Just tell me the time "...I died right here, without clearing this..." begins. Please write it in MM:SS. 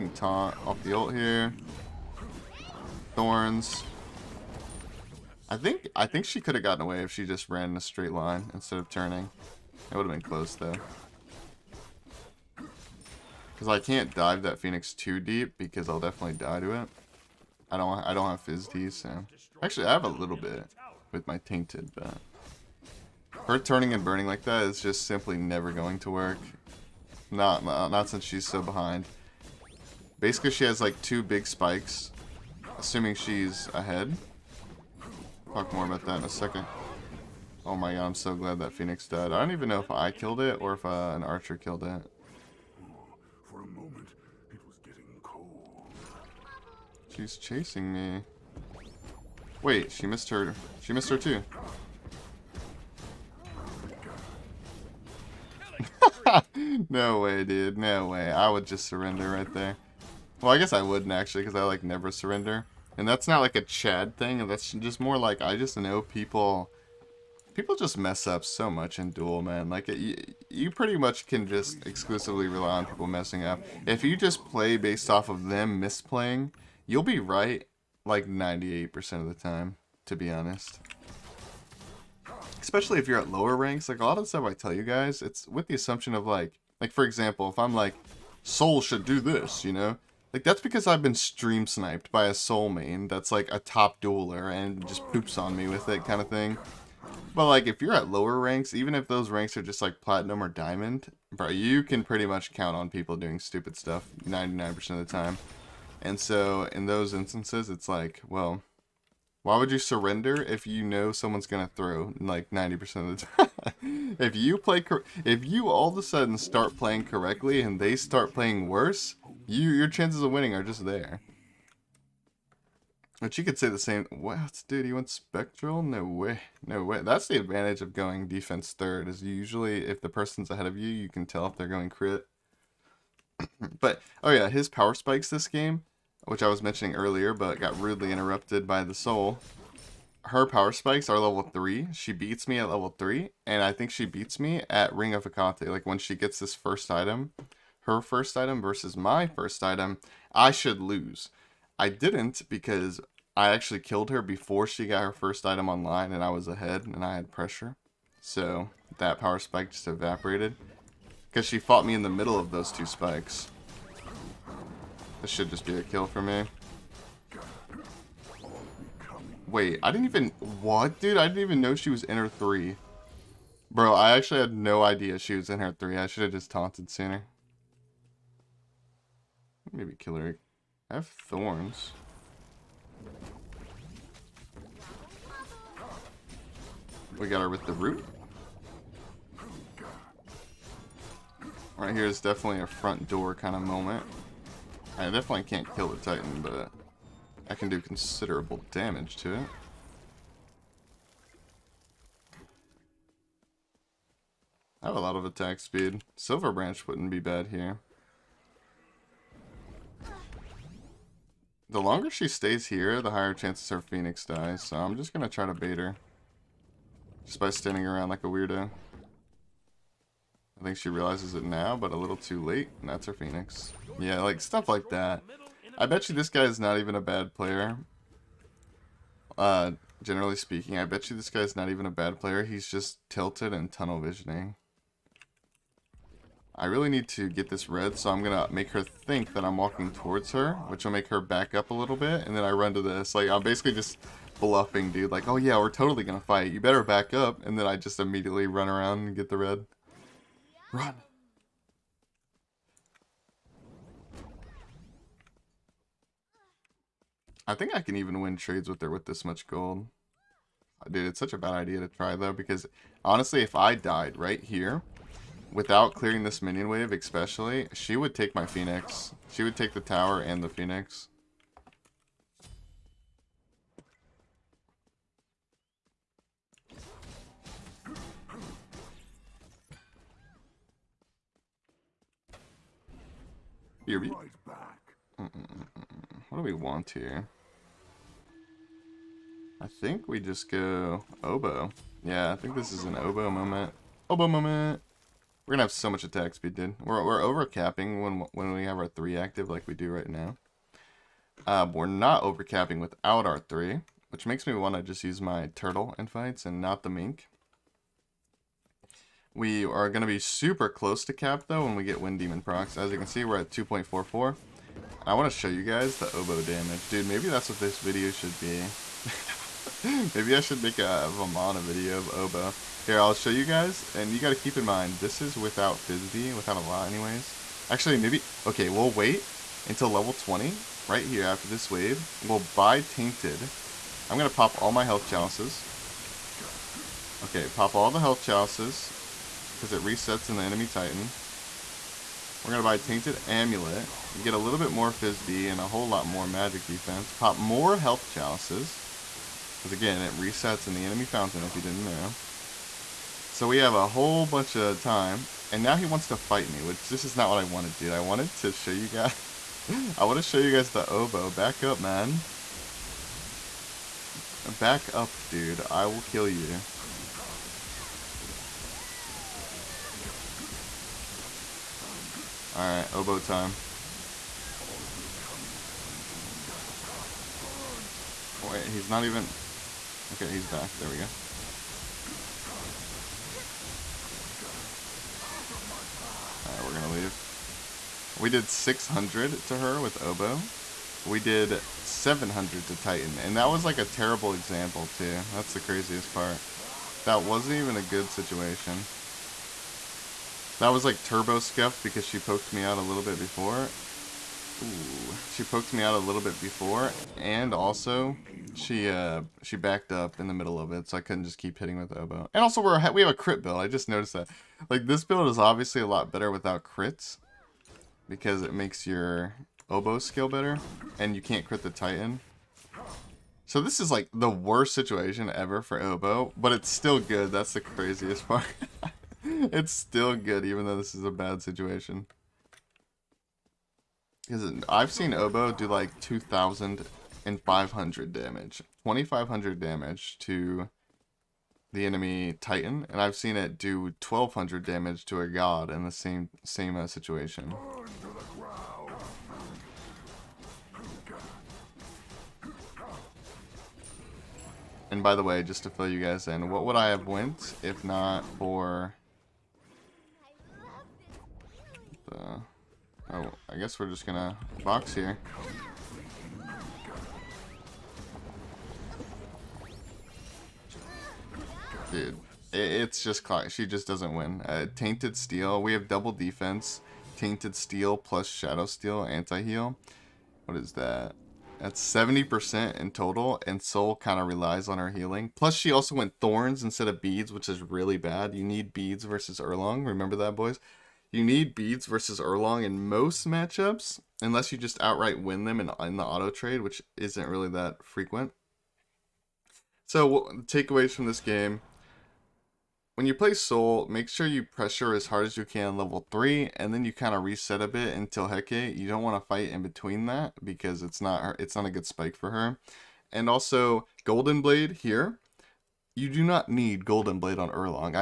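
04:23.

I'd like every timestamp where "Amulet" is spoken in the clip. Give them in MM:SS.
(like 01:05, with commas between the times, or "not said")
05:43.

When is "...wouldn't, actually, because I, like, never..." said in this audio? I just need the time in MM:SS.
01:00.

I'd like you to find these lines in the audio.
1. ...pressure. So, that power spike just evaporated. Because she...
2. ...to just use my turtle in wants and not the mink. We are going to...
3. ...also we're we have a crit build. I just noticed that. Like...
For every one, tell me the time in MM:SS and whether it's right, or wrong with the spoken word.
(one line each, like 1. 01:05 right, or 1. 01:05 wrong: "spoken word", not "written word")
1. 02:37 right
2. 05:04 wrong: "fights", not "wants"
3. 06:52 right.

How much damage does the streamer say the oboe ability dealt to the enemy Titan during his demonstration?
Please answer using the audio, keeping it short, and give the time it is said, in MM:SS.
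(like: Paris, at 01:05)
700, at 06:31.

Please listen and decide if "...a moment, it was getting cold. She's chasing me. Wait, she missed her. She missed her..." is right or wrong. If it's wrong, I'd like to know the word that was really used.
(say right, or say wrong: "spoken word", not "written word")
right.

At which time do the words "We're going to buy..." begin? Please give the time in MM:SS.
05:42.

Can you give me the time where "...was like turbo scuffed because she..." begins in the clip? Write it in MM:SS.
06:40.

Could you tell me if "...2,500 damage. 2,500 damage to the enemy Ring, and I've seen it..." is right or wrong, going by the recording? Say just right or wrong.
wrong.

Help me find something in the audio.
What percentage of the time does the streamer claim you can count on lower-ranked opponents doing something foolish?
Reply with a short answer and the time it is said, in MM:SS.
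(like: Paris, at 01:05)
99%, at 01:44.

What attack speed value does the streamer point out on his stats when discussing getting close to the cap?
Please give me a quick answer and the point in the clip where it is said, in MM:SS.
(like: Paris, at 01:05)
2.44, at 05:13.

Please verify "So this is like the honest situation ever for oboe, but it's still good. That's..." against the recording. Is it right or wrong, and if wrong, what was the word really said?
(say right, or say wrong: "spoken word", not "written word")
wrong: "worst", not "honest".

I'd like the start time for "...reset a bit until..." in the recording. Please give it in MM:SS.
08:27.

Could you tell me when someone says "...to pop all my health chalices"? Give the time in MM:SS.
05:34.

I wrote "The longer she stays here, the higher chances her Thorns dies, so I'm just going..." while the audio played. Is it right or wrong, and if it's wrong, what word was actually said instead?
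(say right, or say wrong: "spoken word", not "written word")
wrong: "Phoenix", not "Thorns".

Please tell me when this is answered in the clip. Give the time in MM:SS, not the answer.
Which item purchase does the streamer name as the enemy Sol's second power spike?
02:24.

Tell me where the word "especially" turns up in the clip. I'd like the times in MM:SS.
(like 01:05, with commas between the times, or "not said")
01:22, 04:26.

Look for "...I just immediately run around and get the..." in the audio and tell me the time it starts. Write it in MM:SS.
04:07.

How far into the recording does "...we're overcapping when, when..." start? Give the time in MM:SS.
04:57.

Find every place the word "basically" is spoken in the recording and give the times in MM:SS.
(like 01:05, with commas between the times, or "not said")
00:30, 04:03.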